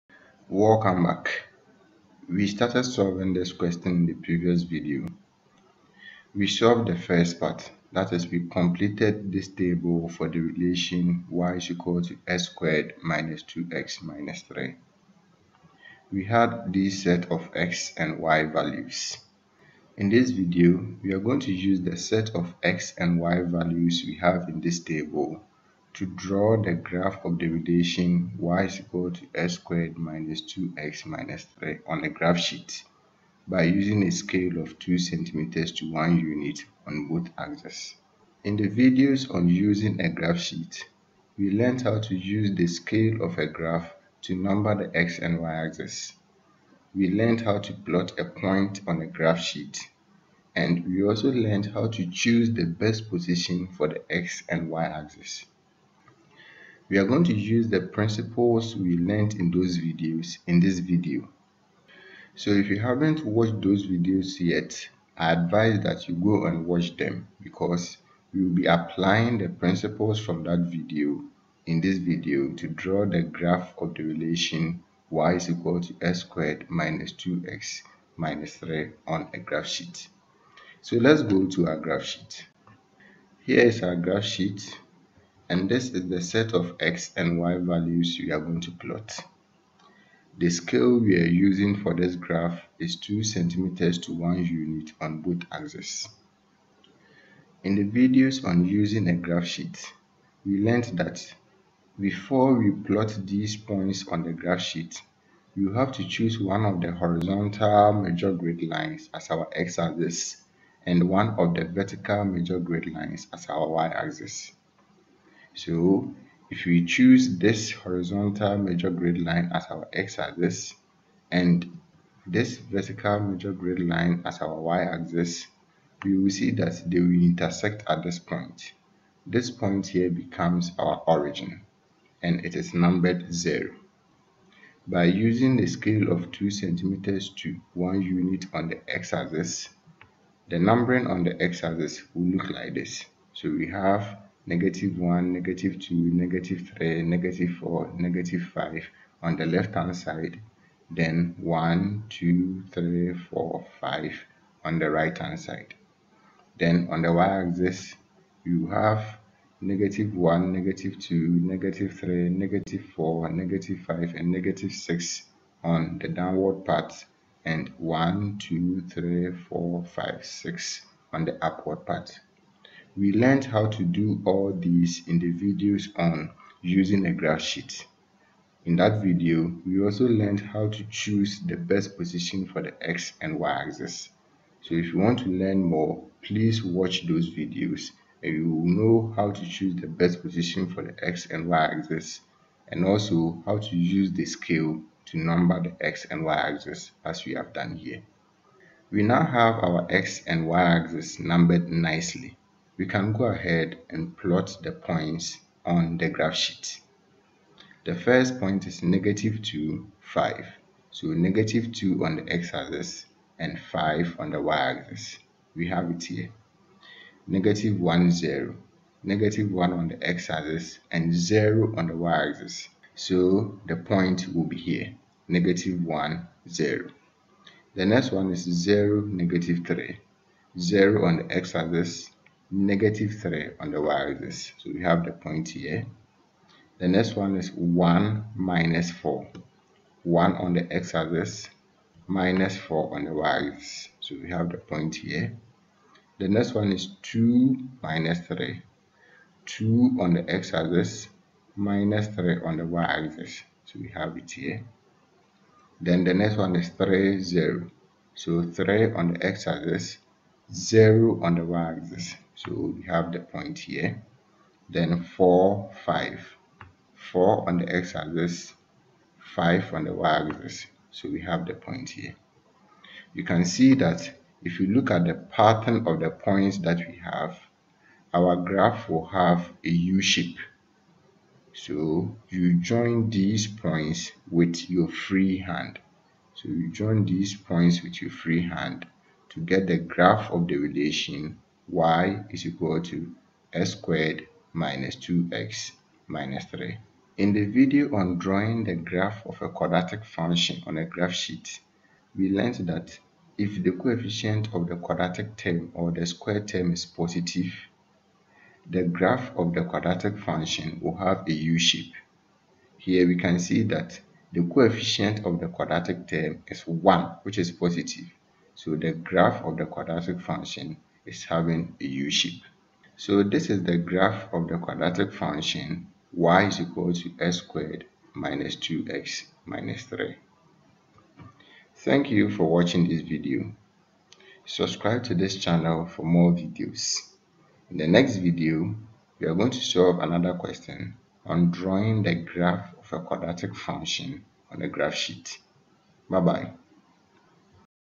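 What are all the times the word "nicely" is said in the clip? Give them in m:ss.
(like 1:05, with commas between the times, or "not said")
3:21.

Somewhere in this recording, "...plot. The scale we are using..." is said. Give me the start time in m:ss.
1:28.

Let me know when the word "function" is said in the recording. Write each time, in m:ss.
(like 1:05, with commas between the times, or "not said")
5:00, 5:10, 5:20, 5:25, 5:43.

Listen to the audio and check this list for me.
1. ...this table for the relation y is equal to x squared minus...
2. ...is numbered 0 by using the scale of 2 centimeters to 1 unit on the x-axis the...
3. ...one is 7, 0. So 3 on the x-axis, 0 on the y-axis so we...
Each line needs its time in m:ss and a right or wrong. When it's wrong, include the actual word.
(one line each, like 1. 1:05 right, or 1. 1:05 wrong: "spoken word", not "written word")
1. 0:09 right
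2. 2:12 right
3. 4:16 wrong: "3", not "7".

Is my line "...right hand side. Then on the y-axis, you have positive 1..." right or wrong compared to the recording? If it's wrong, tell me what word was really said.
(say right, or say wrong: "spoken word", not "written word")
wrong: "negative", not "positive".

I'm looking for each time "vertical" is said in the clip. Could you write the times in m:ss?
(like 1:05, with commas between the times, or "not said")
1:51, 2:02.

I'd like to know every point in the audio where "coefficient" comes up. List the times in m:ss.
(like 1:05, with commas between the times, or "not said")
5:03, 5:14.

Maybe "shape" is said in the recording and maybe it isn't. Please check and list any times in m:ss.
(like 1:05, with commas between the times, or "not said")
4:39, 5:11, 5:21.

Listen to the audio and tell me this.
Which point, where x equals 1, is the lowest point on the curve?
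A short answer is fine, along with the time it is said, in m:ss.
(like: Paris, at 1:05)
(1, -4), at 3:57.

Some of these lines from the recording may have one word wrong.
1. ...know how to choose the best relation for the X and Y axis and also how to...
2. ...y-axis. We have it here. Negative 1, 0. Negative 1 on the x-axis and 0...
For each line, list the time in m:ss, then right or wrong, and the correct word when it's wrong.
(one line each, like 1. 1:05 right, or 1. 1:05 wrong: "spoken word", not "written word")
1. 3:08 wrong: "position", not "relation"
2. 3:34 right.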